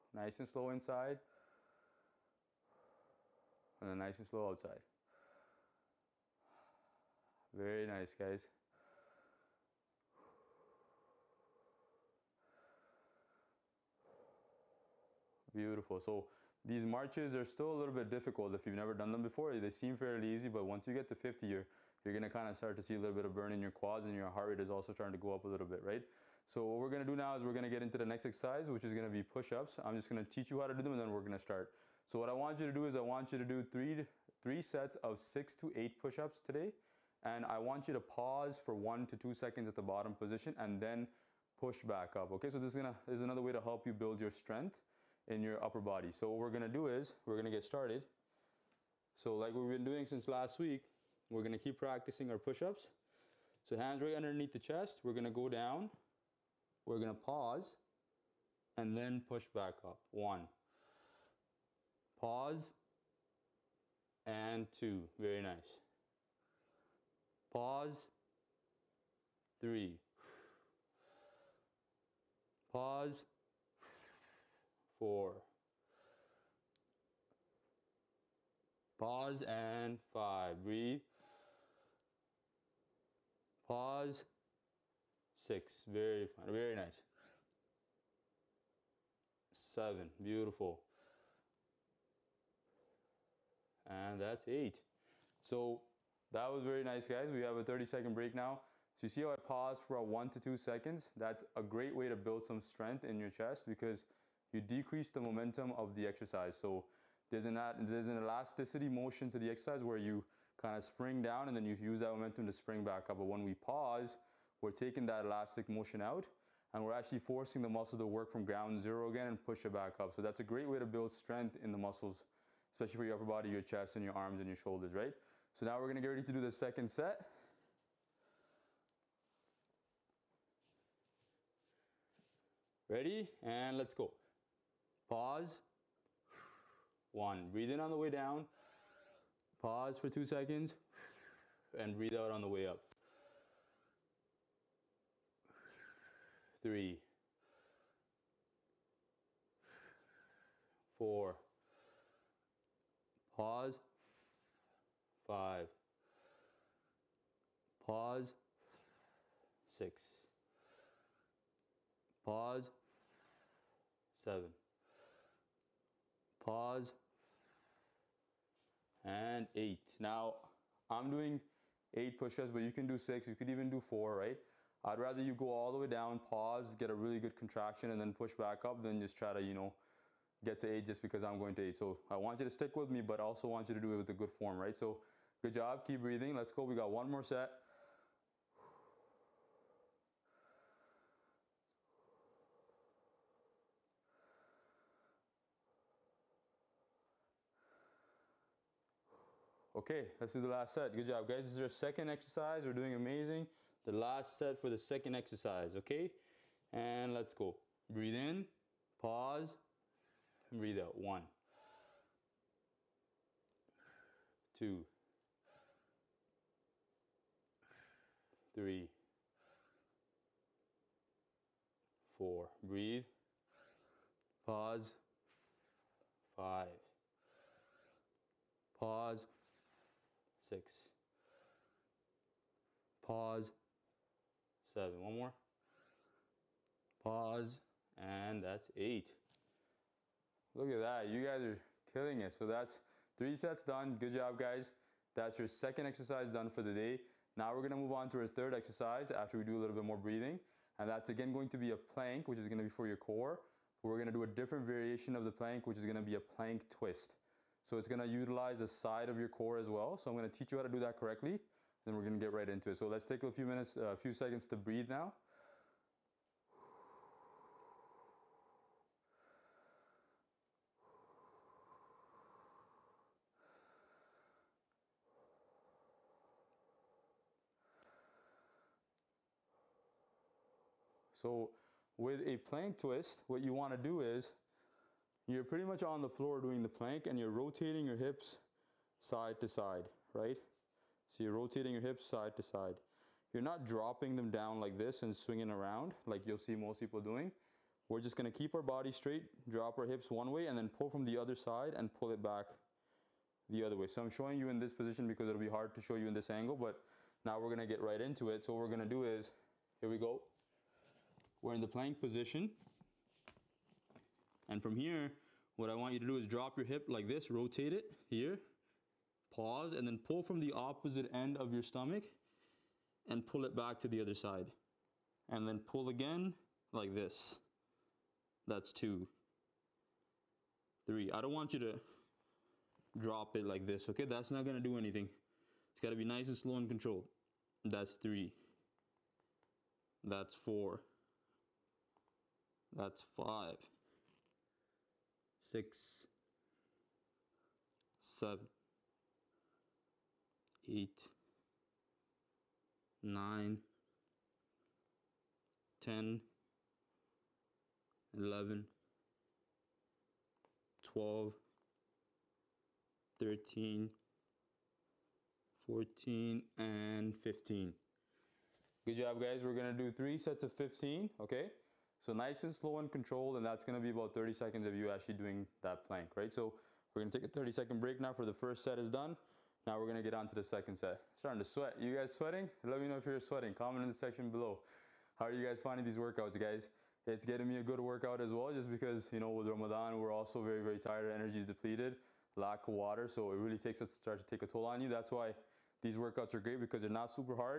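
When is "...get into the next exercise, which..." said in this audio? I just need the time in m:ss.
0:27.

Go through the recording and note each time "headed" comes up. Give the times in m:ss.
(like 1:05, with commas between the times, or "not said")
not said.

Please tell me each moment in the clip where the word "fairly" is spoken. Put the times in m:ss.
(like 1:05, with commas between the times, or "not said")
0:19.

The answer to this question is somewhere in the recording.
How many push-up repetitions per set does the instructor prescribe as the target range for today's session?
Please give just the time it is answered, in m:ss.
0:35.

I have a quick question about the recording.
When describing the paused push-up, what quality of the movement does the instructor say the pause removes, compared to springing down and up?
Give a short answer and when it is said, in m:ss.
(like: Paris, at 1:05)
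elasticity, at 1:48.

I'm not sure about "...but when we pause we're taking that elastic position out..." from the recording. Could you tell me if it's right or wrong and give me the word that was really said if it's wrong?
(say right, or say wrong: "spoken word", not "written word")
wrong: "motion", not "position".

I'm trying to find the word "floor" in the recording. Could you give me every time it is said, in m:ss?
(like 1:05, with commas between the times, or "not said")
4:46.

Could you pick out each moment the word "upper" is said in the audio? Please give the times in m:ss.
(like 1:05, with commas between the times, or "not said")
0:45, 2:03.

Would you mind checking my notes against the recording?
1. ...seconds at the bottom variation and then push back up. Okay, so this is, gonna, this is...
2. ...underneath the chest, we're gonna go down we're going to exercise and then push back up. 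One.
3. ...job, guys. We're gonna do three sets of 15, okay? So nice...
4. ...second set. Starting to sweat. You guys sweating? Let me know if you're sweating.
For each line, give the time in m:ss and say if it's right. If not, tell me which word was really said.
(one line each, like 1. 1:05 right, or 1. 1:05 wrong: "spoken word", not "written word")
1. 0:39 wrong: "position", not "variation"
2. 0:54 wrong: "pause", not "exercise"
3. 6:08 right
4. 6:20 right.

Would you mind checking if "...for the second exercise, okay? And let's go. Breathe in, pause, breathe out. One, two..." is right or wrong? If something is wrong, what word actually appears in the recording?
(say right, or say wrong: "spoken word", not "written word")
right.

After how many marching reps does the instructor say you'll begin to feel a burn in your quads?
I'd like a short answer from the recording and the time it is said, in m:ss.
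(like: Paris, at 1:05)
50, at 0:21.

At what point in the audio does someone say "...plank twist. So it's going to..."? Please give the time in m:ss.
4:16.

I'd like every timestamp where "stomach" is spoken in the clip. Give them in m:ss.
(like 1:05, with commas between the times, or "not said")
5:21.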